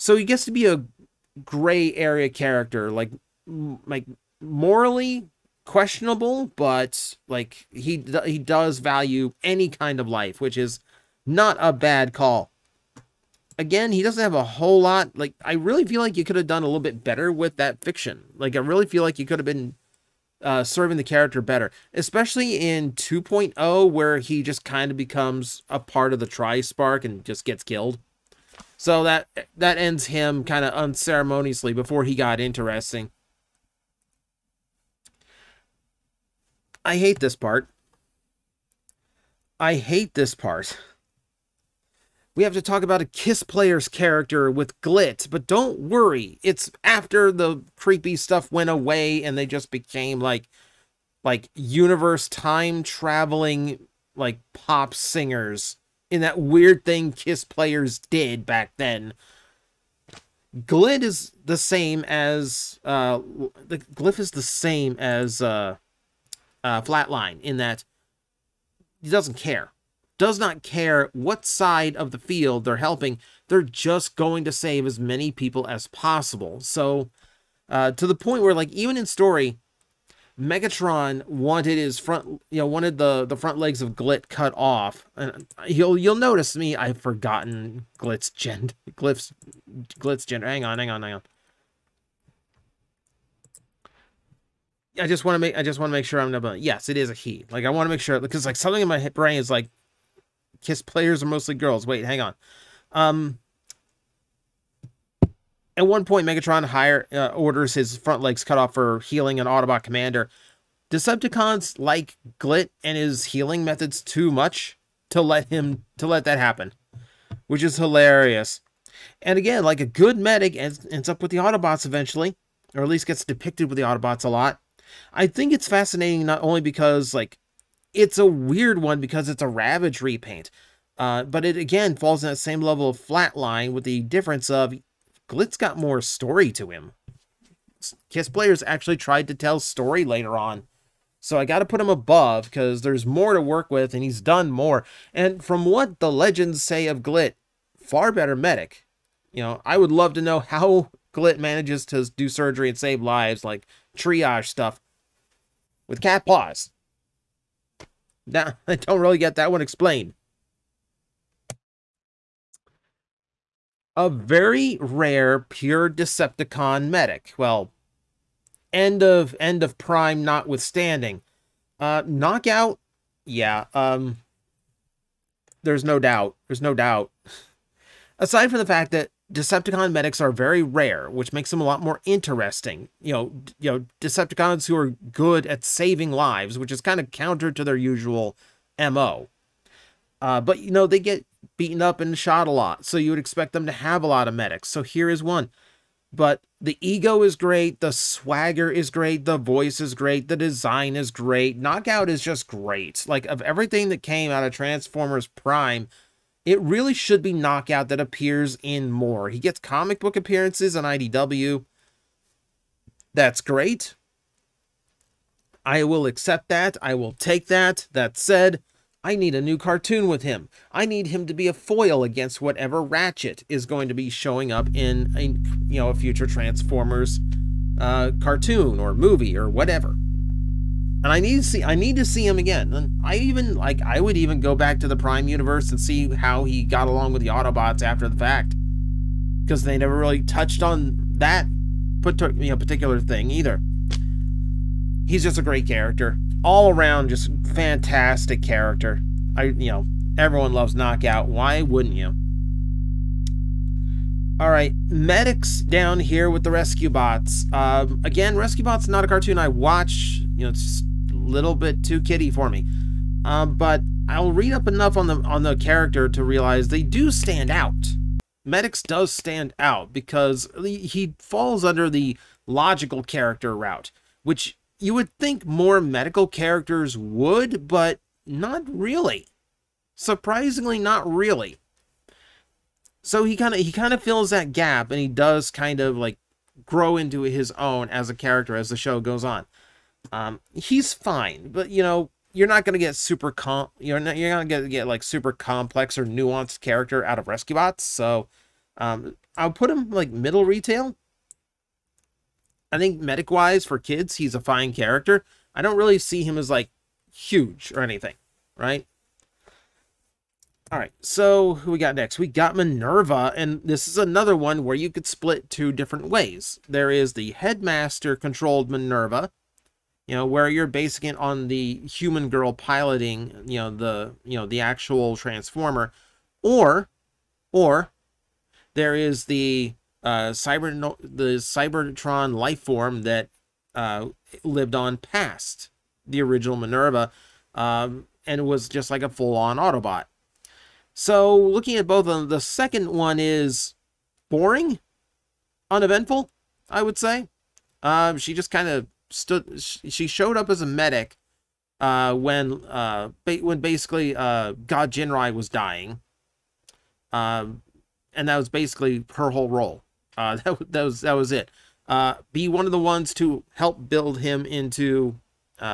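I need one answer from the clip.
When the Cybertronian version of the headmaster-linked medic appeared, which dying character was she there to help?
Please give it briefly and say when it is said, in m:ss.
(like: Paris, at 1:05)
God Jinrai, at 5:54.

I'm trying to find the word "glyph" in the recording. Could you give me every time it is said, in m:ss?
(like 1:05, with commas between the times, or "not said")
1:03.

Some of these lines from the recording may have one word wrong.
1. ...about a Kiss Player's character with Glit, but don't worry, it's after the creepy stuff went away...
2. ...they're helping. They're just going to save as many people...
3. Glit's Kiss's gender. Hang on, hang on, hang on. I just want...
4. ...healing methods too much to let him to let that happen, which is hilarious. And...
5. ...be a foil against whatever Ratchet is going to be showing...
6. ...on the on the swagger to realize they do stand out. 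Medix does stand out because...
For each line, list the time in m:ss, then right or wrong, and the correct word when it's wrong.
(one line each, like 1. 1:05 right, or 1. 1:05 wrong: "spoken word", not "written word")
1. 0:42 right
2. 1:12 right
3. 1:28 wrong: "Glit", not "Kiss"
4. 1:53 right
5. 3:41 right
6. 4:24 wrong: "character", not "swagger".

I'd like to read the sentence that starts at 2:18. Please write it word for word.
Kiss players actually tried to tell story later on.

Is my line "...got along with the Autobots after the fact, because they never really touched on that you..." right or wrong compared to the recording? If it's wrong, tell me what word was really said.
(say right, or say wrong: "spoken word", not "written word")
right.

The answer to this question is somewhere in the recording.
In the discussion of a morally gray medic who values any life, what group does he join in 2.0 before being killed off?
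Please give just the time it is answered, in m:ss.
0:26.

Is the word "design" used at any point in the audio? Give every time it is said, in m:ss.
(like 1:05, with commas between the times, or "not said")
3:20.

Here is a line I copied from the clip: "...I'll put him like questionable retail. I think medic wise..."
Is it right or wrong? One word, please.
wrong.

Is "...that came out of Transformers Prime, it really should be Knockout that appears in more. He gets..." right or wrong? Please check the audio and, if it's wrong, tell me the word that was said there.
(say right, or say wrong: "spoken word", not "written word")
right.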